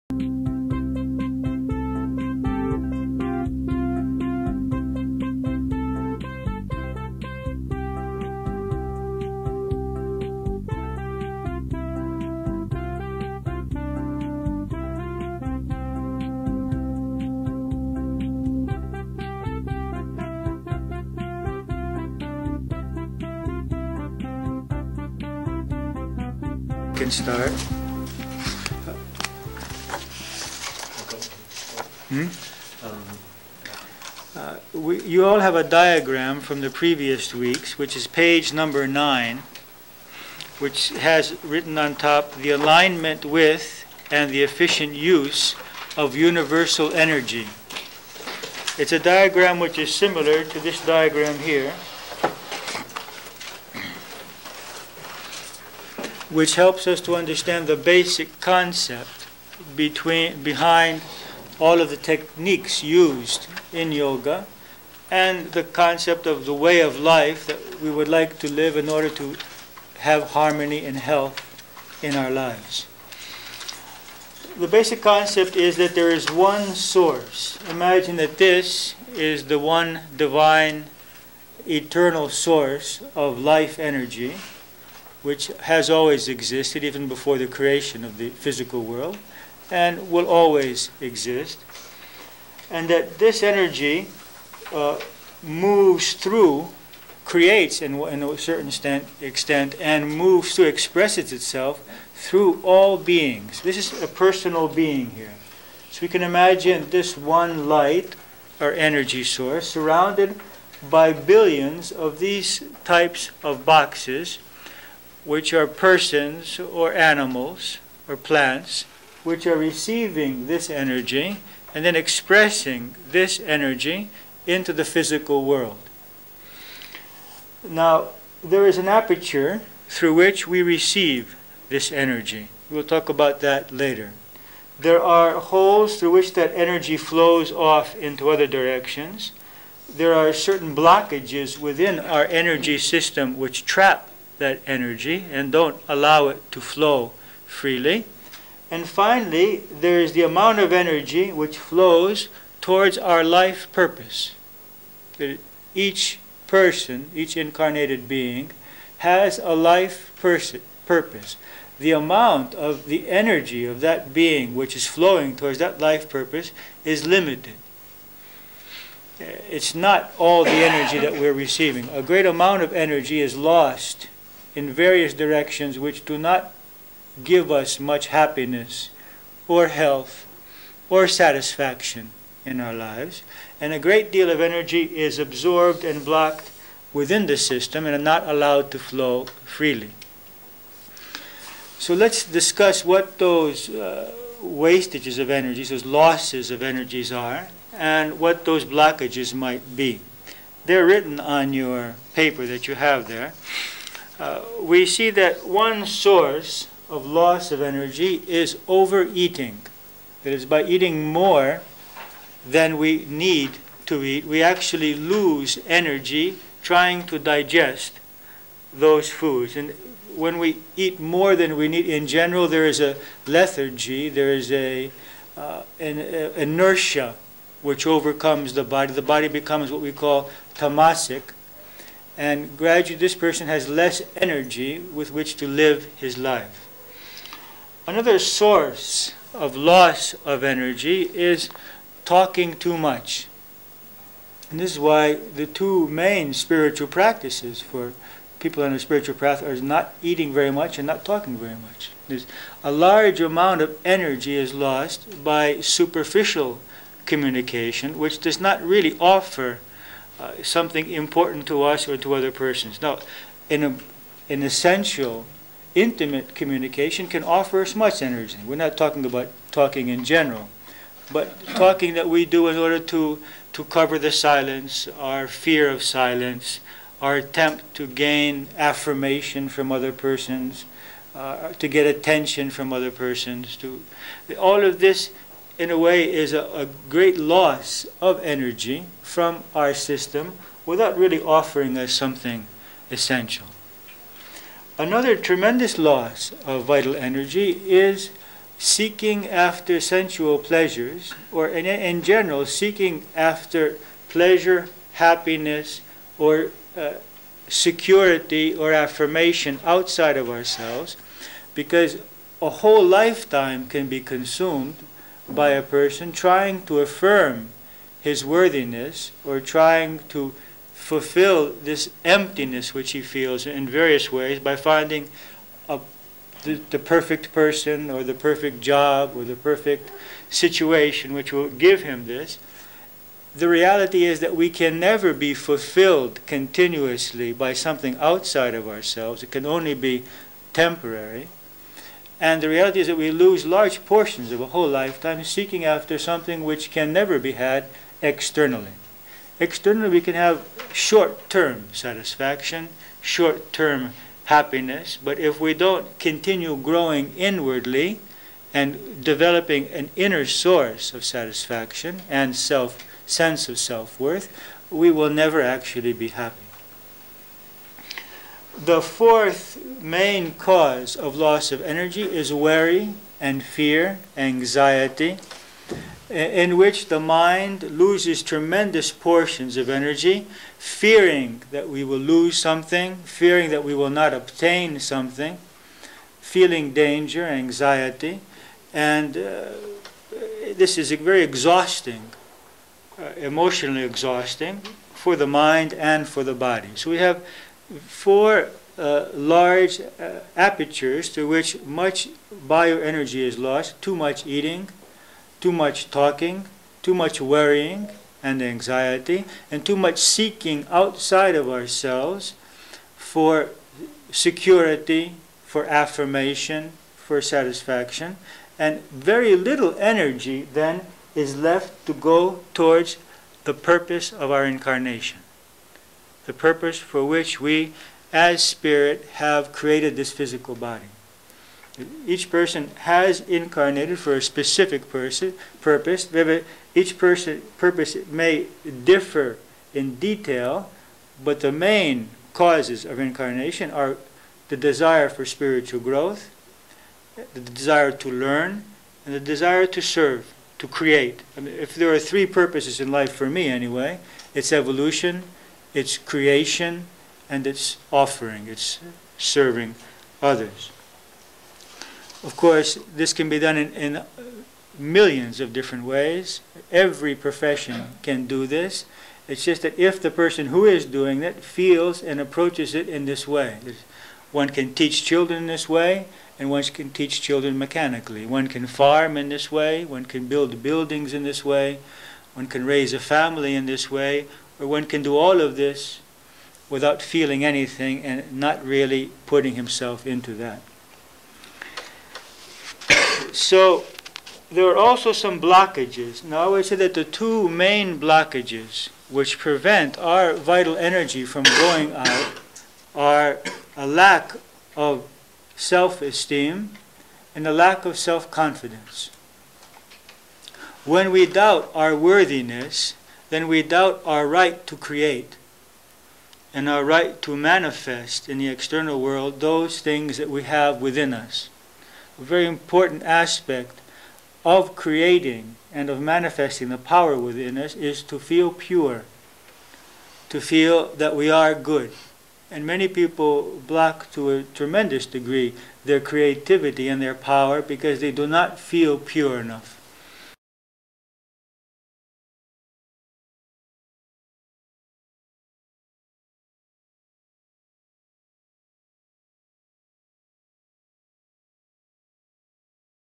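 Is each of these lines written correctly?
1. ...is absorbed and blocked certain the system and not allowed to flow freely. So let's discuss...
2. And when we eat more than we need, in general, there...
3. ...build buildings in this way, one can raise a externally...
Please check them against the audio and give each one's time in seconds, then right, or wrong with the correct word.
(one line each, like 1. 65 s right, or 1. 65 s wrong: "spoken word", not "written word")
1. 184 s wrong: "within", not "certain"
2. 219 s right
3. 480 s wrong: "family", not "externally".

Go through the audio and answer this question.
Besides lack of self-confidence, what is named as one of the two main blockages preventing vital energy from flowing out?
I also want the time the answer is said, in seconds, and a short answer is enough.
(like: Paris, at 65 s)
lack of self-esteem, at 503 s.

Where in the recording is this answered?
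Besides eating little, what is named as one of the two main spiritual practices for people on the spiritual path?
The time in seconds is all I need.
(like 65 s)
250 s.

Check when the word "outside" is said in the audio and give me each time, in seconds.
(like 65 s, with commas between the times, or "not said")
309 s, 337 s, 410 s.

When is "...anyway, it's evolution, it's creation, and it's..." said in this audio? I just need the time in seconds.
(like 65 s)
453 s.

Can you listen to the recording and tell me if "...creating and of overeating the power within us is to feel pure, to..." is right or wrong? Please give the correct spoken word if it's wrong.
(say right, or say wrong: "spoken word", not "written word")
wrong: "manifesting", not "overeating".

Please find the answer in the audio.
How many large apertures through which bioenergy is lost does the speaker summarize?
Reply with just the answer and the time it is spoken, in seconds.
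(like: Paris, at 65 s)
4, at 397 s.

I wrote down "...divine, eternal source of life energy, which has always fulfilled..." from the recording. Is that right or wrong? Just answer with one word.
wrong.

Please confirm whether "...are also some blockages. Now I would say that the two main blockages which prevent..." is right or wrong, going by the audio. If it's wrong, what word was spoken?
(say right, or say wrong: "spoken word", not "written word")
right.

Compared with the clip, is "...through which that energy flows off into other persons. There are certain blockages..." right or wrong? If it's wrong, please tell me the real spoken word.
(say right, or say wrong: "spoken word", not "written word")
wrong: "directions", not "persons".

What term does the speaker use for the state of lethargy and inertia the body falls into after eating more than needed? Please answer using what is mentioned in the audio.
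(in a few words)
tamasic.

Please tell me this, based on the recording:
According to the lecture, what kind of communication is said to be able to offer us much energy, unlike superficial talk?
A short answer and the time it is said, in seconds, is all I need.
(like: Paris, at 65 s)
essential intimate communication, at 264 s.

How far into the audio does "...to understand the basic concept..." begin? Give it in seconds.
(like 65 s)
57 s.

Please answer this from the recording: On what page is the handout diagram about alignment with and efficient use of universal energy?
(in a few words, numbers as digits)
9.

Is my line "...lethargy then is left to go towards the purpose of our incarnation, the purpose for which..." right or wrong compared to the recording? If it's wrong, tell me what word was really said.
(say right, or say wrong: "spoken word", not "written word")
wrong: "energy", not "lethargy".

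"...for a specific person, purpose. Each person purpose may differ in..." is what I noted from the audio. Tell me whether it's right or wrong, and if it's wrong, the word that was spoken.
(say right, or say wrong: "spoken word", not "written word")
right.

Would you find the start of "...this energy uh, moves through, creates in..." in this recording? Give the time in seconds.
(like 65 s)
93 s.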